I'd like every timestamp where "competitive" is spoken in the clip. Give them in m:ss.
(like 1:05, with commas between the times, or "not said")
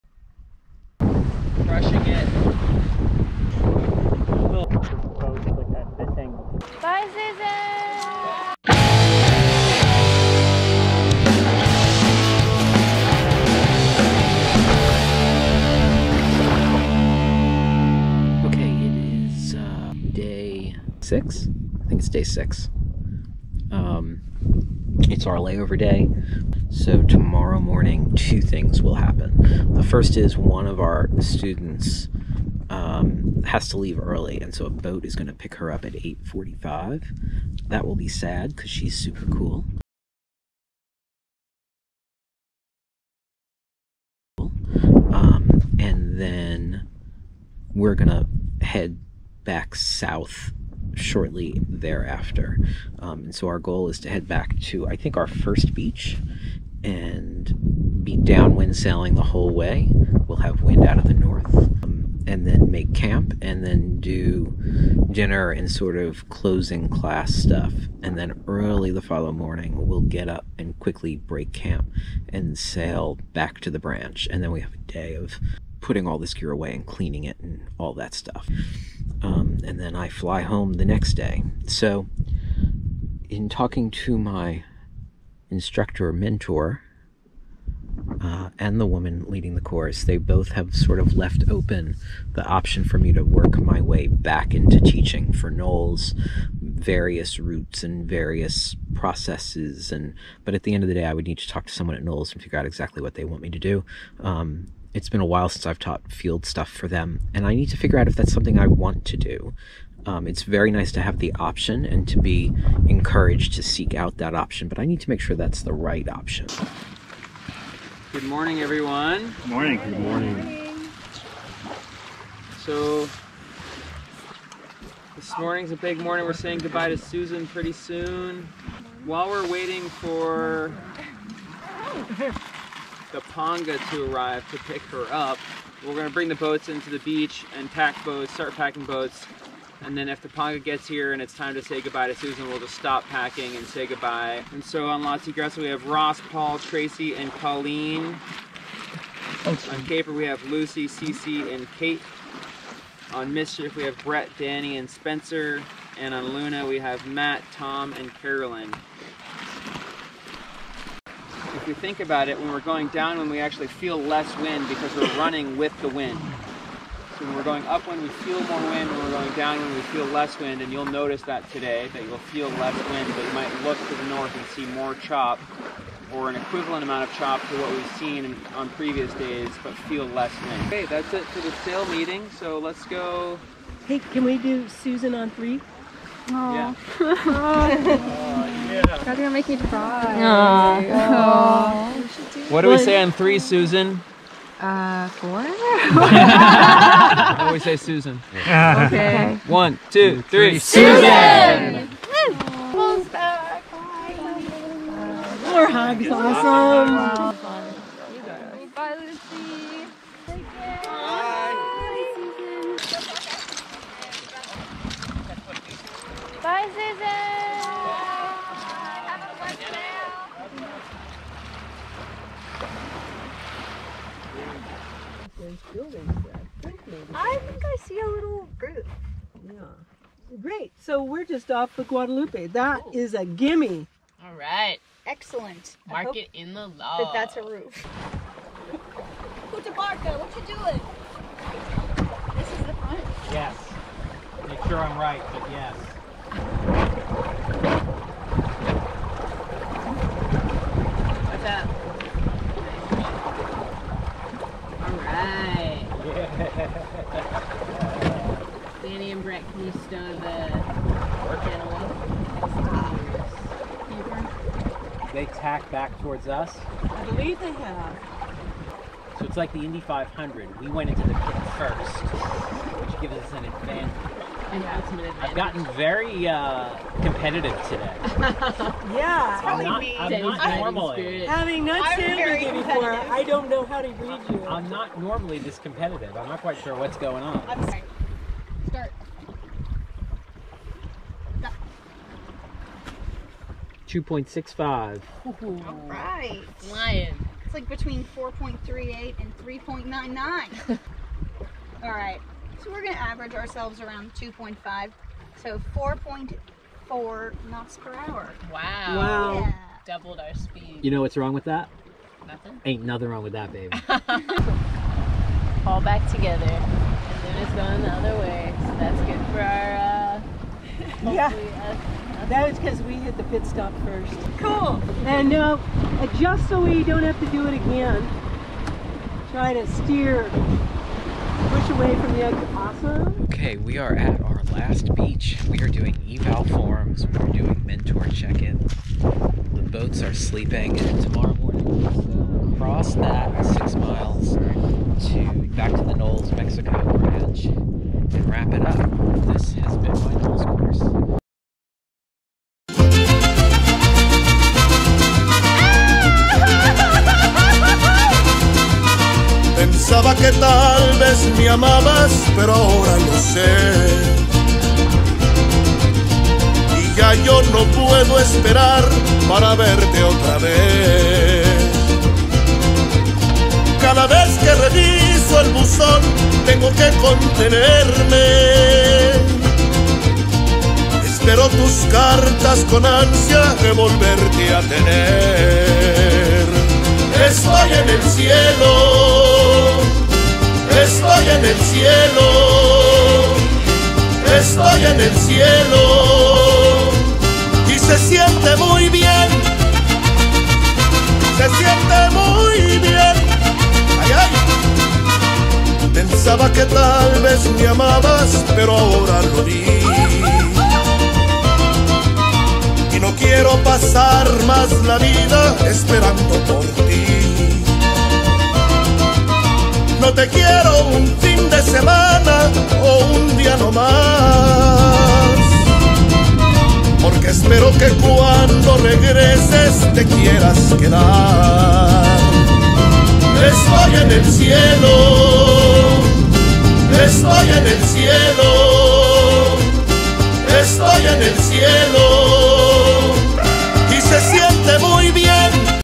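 4:37, 4:45.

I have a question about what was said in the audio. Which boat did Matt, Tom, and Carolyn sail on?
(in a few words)
Luna.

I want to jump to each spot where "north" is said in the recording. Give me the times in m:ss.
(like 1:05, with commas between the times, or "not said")
1:01, 2:54.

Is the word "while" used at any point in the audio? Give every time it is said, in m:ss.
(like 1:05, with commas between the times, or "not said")
1:45, 2:09.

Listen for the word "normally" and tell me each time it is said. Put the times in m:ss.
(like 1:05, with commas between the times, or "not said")
4:40, 4:45.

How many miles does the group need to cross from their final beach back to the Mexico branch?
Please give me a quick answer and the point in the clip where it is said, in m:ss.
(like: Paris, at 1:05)
6, at 5:43.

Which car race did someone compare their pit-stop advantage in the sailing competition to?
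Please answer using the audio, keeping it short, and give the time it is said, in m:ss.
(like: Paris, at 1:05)
Indy 500, at 4:29.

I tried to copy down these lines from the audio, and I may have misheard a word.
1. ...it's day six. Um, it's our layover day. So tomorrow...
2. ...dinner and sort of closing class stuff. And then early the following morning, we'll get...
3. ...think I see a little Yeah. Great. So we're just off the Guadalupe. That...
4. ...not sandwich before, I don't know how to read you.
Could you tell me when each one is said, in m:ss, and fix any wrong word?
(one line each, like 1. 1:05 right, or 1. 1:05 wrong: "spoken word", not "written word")
1. 0:22 right
2. 1:05 right
3. 3:47 right
4. 4:41 right.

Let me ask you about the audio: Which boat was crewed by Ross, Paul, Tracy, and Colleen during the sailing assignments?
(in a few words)
La Tigresa.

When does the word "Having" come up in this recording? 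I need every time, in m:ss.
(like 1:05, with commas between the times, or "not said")
4:41.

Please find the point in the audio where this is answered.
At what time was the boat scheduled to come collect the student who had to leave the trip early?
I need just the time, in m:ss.
0:35.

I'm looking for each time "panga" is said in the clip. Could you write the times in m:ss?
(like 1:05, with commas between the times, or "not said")
2:13, 2:20.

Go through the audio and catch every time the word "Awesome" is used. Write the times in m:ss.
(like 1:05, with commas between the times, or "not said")
3:26, 5:32.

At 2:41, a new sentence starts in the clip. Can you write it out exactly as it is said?
If you think about it, when we're going down, when we actually feel less wind because we're running with the wind.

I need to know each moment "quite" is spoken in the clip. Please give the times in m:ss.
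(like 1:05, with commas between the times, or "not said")
4:46.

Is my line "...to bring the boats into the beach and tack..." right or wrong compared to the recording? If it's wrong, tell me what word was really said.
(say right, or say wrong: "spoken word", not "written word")
right.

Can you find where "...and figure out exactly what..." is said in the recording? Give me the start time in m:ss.
1:42.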